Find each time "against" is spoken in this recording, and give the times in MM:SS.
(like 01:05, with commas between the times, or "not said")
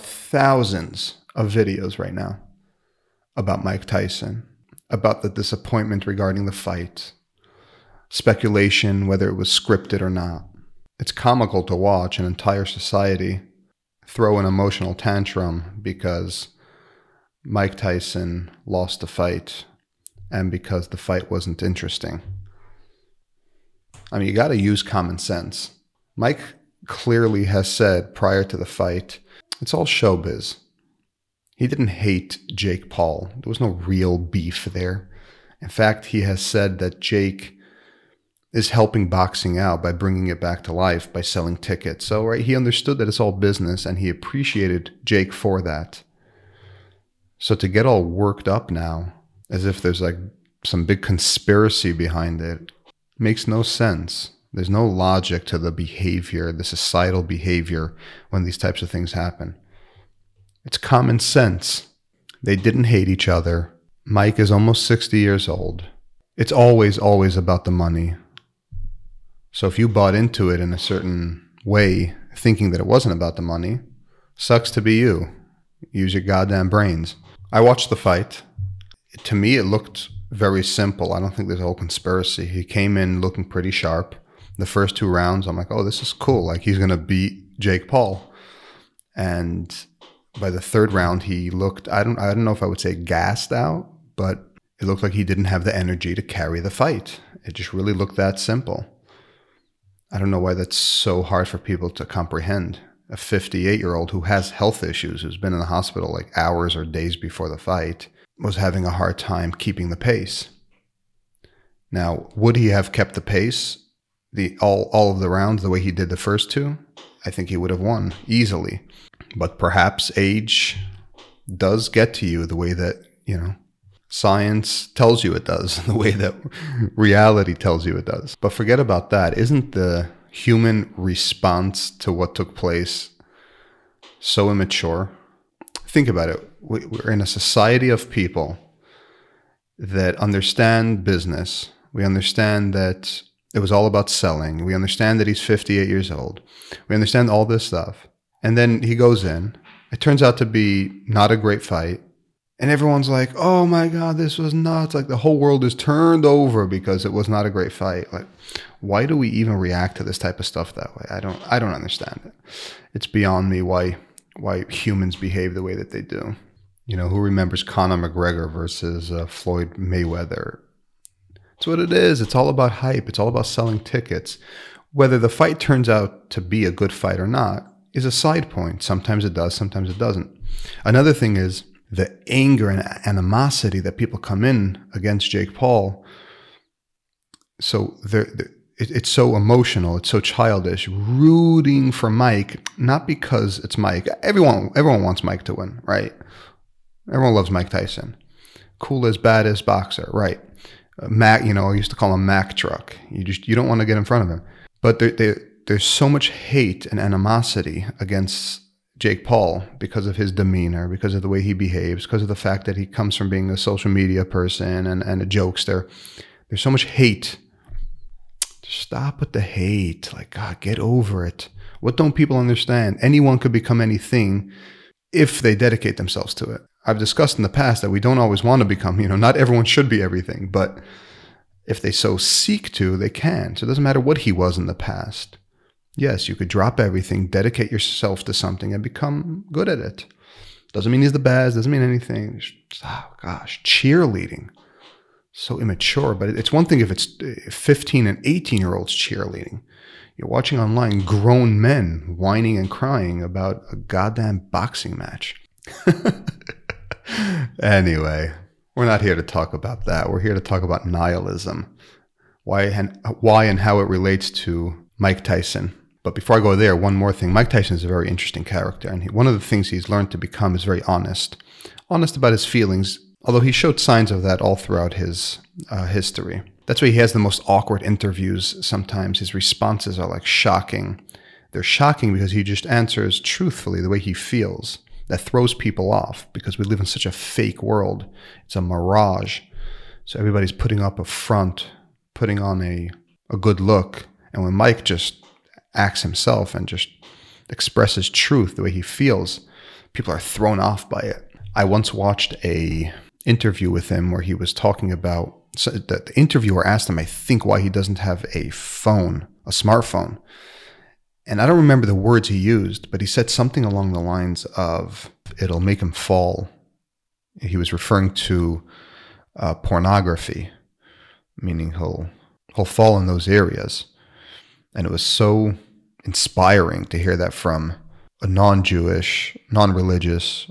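03:04, 03:27.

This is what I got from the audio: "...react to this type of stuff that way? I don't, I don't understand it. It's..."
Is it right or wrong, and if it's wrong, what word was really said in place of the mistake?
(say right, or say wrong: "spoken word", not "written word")
right.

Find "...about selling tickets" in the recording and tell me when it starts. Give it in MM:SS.
02:53.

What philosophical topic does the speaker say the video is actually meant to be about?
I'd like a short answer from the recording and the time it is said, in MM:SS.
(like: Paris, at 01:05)
nihilism, at 04:20.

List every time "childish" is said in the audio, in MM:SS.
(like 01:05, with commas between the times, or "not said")
03:10.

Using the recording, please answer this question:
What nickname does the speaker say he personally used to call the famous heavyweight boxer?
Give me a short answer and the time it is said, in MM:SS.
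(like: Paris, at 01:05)
Mack Truck, at 03:22.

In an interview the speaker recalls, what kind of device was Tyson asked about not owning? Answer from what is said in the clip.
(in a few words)
a smartphone.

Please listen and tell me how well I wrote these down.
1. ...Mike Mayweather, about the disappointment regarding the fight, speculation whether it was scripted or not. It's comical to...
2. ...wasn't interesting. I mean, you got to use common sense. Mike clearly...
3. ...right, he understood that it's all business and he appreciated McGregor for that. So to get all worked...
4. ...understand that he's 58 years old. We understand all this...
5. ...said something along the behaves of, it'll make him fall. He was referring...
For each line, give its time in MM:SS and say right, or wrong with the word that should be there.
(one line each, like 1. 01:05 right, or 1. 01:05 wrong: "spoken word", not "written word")
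1. 00:03 wrong: "Tyson", not "Mayweather"
2. 00:21 right
3. 00:42 wrong: "Jake", not "McGregor"
4. 02:24 right
5. 05:13 wrong: "lines", not "behaves".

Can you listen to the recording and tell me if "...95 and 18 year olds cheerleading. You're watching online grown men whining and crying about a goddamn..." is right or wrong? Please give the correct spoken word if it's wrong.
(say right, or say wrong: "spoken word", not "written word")
wrong: "15", not "95".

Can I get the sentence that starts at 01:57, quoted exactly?
I think he would have won easily.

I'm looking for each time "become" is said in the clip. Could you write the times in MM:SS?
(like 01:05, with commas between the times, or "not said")
03:43, 03:48, 03:58, 04:30.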